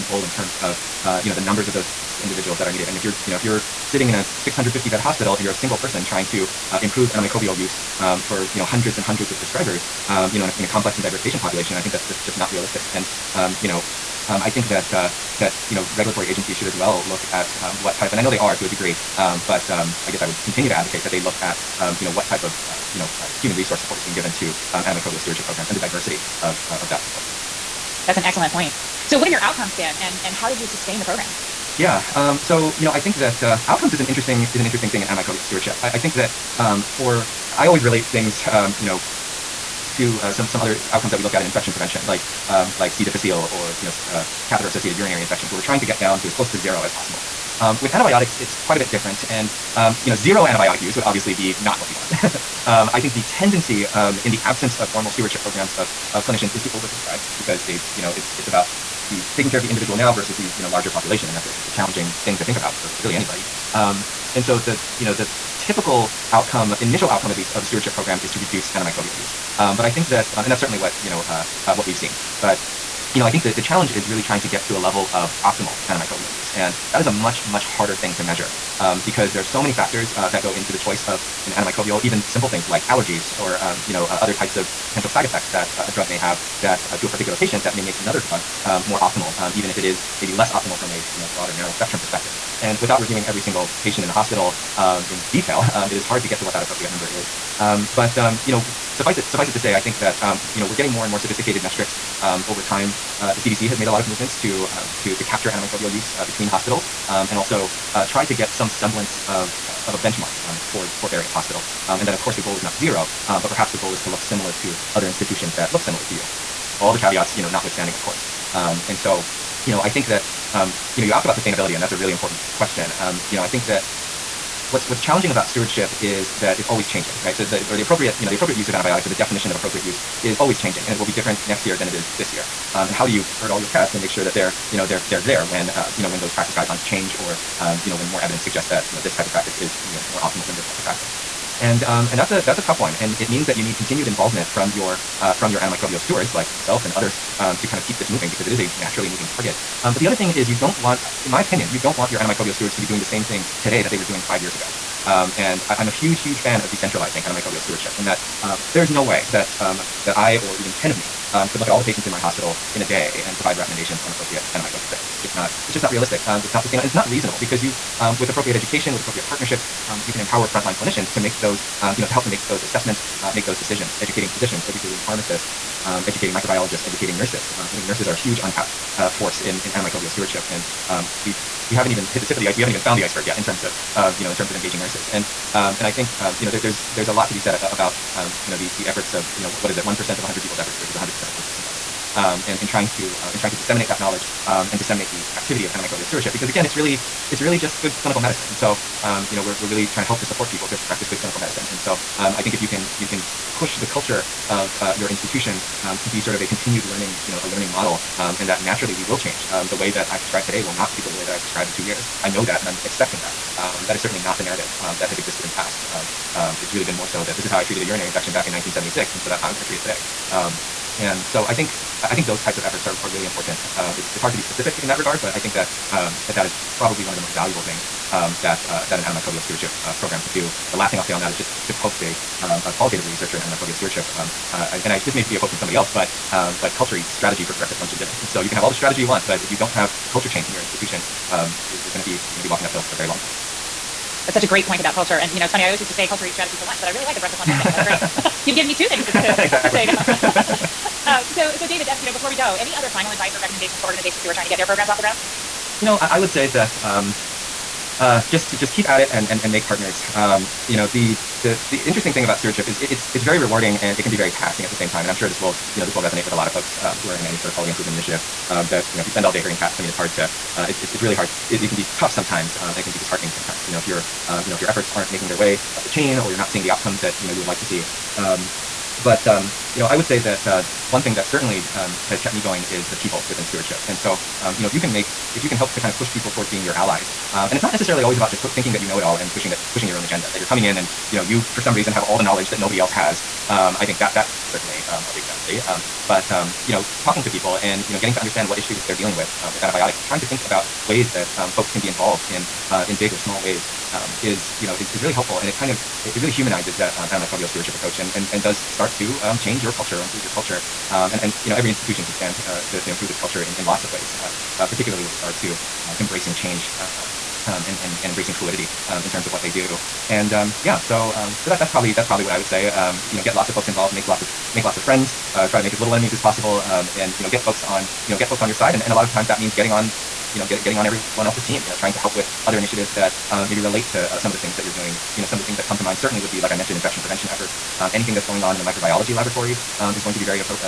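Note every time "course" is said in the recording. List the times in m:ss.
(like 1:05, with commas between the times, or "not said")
1:52, 1:58.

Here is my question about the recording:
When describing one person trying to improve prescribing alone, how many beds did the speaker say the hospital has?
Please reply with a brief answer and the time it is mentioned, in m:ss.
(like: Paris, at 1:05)
650, at 0:04.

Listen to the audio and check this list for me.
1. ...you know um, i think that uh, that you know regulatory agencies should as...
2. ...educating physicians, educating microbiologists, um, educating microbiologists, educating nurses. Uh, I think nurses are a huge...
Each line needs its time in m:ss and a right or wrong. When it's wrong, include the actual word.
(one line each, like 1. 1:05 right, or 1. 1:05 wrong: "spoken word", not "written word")
1. 0:13 right
2. 2:54 wrong: "pharmacists", not "microbiologists".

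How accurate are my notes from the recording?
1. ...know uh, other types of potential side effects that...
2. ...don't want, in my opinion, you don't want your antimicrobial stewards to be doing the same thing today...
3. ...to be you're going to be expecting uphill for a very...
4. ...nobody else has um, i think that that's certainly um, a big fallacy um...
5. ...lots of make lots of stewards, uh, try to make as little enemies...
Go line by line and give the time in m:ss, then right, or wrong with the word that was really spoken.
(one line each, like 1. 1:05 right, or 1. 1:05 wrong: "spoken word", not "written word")
1. 1:23 right
2. 2:30 right
3. 4:01 wrong: "walking", not "expecting"
4. 4:52 right
5. 5:24 wrong: "friends", not "stewards".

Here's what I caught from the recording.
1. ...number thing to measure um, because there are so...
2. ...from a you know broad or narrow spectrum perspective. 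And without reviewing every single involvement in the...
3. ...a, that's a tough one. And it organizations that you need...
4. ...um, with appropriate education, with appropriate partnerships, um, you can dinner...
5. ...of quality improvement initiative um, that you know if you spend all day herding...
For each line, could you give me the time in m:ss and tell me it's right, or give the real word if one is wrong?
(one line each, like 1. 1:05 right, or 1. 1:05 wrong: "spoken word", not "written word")
1. 1:17 wrong: "harder", not "number"
2. 1:30 wrong: "patient", not "involvement"
3. 2:22 wrong: "means", not "organizations"
4. 2:48 wrong: "empower", not "dinner"
5. 4:27 right.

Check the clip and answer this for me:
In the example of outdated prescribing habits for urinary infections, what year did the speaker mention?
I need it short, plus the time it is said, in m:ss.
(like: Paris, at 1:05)
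1976, at 3:38.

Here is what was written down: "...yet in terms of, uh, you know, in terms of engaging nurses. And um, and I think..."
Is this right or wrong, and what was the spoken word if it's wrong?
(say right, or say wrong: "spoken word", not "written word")
right.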